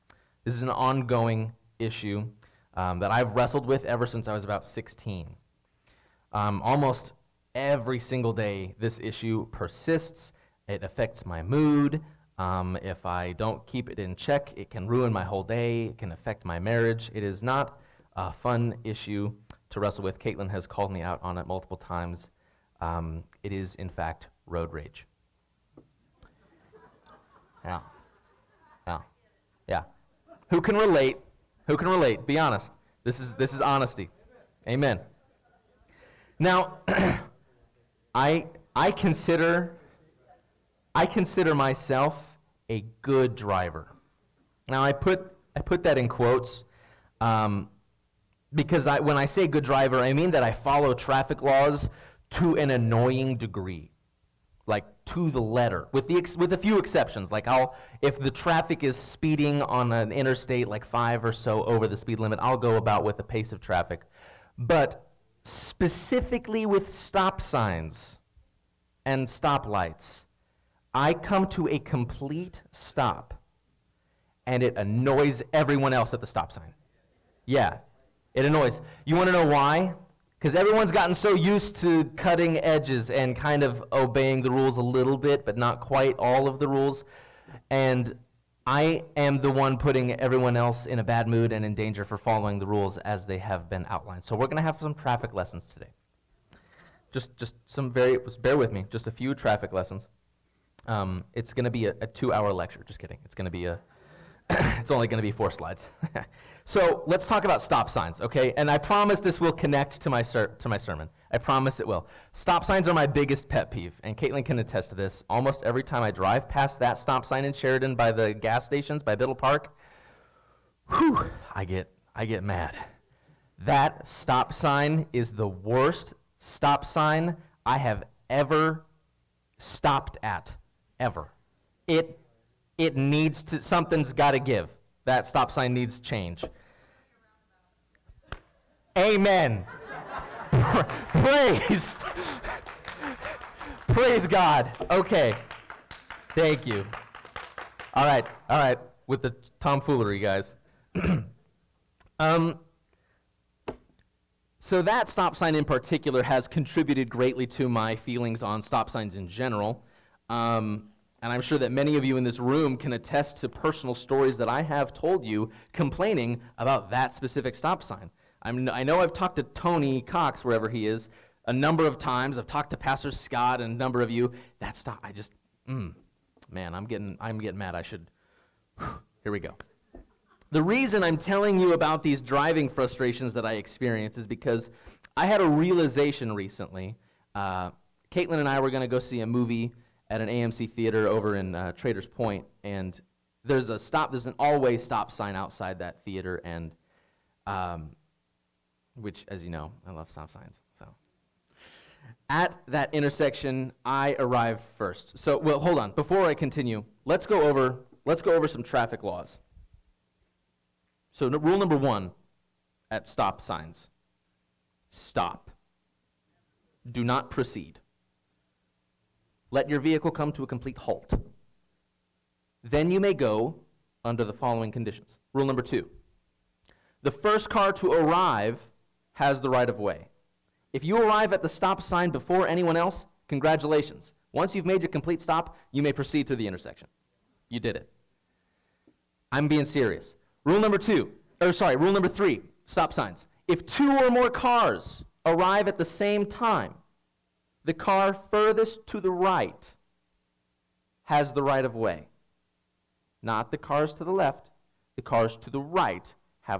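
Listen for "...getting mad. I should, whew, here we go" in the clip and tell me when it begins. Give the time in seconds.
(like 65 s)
177 s.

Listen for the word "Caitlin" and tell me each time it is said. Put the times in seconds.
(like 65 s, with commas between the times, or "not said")
20 s, 114 s, 188 s.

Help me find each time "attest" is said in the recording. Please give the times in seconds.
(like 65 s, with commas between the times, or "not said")
114 s, 162 s.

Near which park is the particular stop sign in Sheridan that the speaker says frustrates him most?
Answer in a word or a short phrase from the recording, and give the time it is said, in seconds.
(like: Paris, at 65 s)
Biddle Park, at 119 s.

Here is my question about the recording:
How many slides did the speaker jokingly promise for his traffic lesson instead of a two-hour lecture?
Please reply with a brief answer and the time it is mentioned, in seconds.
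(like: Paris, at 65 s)
4, at 105 s.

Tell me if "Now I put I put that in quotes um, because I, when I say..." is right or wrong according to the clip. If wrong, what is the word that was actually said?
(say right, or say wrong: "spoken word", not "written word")
right.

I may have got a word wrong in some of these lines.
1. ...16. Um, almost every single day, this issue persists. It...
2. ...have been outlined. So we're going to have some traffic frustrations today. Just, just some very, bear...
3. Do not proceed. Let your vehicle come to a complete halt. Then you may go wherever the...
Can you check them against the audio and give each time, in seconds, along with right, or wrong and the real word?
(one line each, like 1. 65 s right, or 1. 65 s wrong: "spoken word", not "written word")
1. 4 s right
2. 93 s wrong: "lessons", not "frustrations"
3. 216 s wrong: "under", not "wherever".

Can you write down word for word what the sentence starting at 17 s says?
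It is not a fun issue to wrestle with.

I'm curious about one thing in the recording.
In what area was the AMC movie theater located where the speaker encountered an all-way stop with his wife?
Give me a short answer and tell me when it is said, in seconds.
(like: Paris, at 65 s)
Traders Point, at 191 s.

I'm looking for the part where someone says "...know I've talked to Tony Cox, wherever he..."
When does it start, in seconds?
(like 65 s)
168 s.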